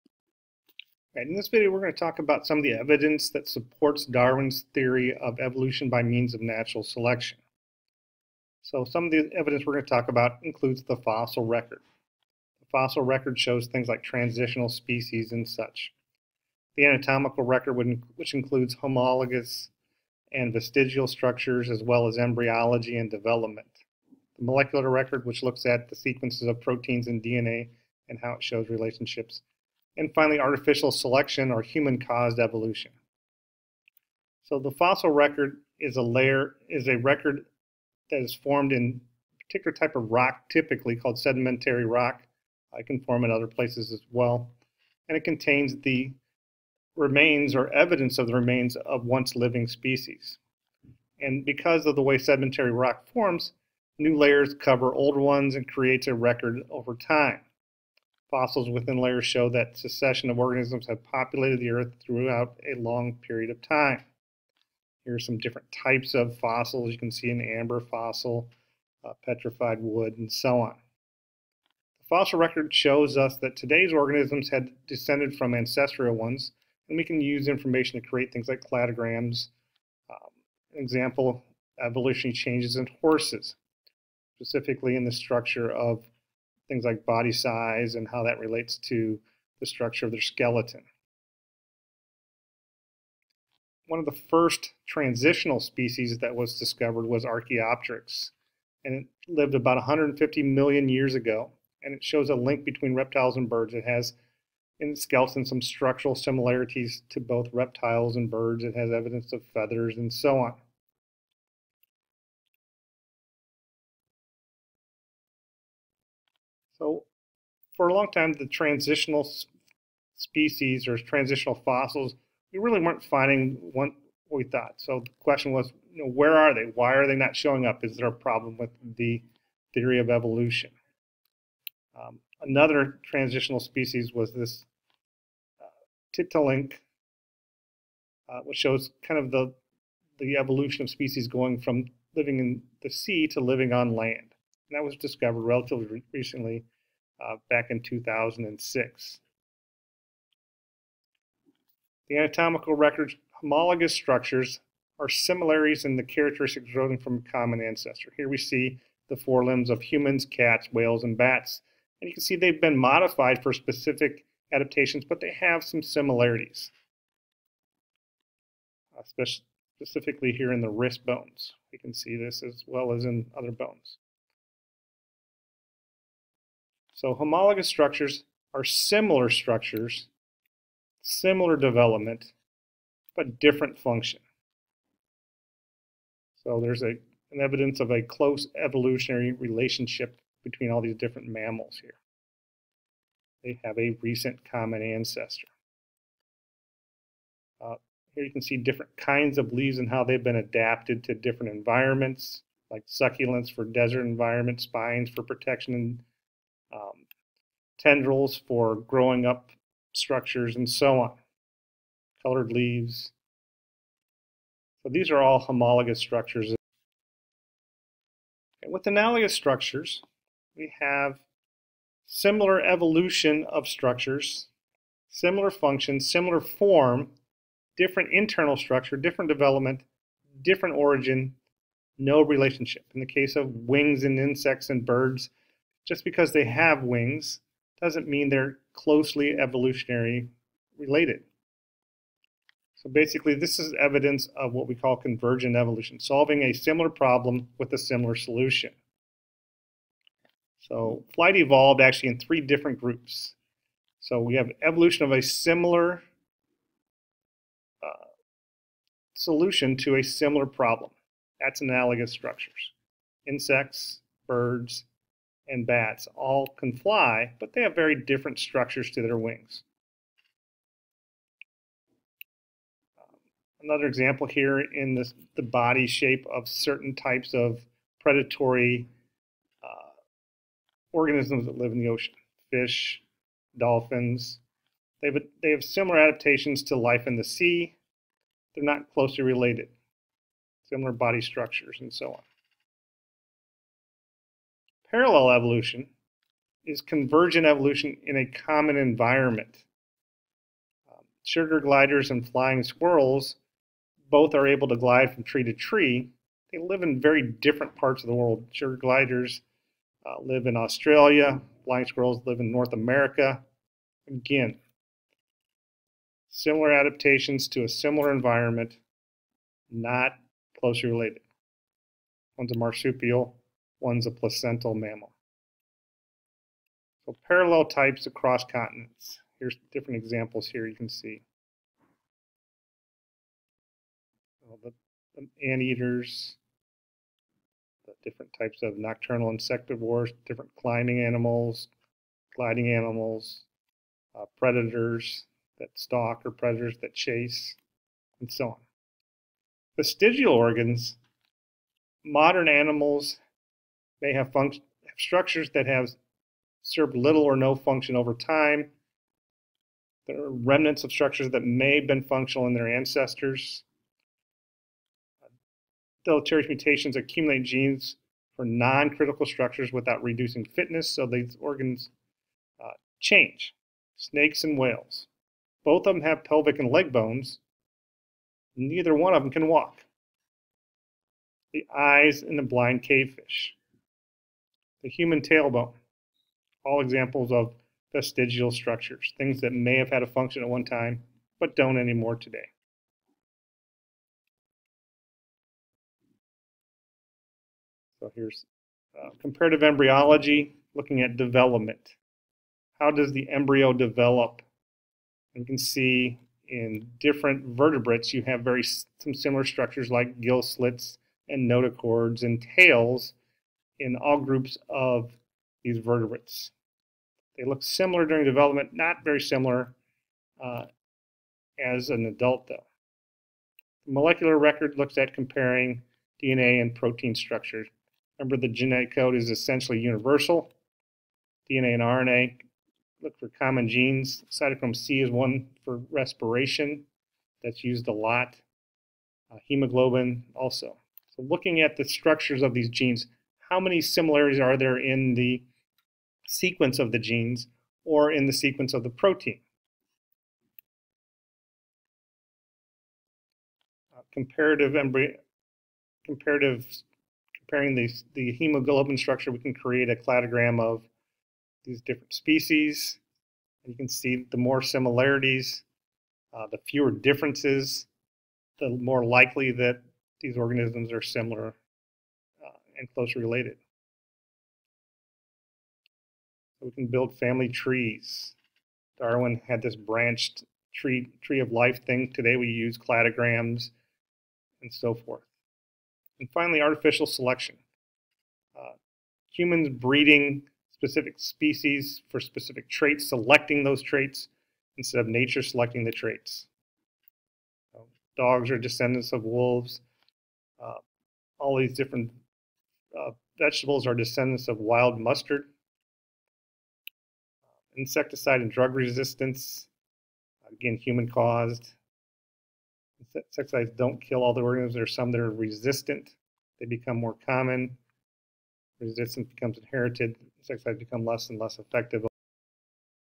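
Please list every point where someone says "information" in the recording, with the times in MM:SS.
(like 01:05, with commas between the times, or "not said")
01:17.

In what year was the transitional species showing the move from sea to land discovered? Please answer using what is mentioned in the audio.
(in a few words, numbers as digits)
2006.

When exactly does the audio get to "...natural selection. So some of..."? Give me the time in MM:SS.
00:06.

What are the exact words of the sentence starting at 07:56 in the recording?
So we can build family trees.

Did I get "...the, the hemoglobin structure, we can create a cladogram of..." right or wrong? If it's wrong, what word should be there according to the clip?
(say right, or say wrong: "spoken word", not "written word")
right.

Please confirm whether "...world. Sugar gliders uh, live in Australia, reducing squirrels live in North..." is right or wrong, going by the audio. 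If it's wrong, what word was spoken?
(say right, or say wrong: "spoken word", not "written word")
wrong: "flying", not "reducing".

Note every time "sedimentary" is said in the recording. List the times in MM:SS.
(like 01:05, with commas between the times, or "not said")
00:41, 00:52.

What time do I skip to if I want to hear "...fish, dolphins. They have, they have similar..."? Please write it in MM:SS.
04:42.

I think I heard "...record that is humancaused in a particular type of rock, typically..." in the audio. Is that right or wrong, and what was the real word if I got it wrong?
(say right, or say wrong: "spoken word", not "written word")
wrong: "formed", not "humancaused".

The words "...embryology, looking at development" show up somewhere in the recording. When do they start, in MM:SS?
06:39.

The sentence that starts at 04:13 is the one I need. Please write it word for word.
So we have evolution of a similar uh, solution to a similar problem.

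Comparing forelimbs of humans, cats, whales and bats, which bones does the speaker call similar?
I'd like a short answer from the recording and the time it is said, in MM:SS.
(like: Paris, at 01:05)
Wrist bones, at 02:50.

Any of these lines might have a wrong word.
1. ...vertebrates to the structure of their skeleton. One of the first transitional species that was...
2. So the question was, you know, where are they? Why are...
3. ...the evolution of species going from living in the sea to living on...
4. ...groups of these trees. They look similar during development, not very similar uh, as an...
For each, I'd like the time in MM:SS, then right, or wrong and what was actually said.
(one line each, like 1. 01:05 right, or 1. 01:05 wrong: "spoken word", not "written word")
1. 01:28 wrong: "relates", not "vertebrates"
2. 02:04 right
3. 02:20 right
4. 06:54 wrong: "vertebrates", not "trees".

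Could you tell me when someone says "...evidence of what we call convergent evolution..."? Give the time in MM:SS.
04:03.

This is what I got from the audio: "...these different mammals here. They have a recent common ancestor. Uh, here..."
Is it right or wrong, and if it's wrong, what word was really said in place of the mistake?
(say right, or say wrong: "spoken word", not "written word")
right.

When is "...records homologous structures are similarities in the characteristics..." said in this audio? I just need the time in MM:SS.
02:32.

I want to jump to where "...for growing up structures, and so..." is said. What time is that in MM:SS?
03:28.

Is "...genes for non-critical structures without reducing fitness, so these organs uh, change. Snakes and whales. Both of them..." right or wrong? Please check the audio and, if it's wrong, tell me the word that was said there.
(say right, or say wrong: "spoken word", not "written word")
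right.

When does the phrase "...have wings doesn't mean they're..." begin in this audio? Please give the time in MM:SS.
03:56.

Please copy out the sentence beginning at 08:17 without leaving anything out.
So dogs are descendants of wolves.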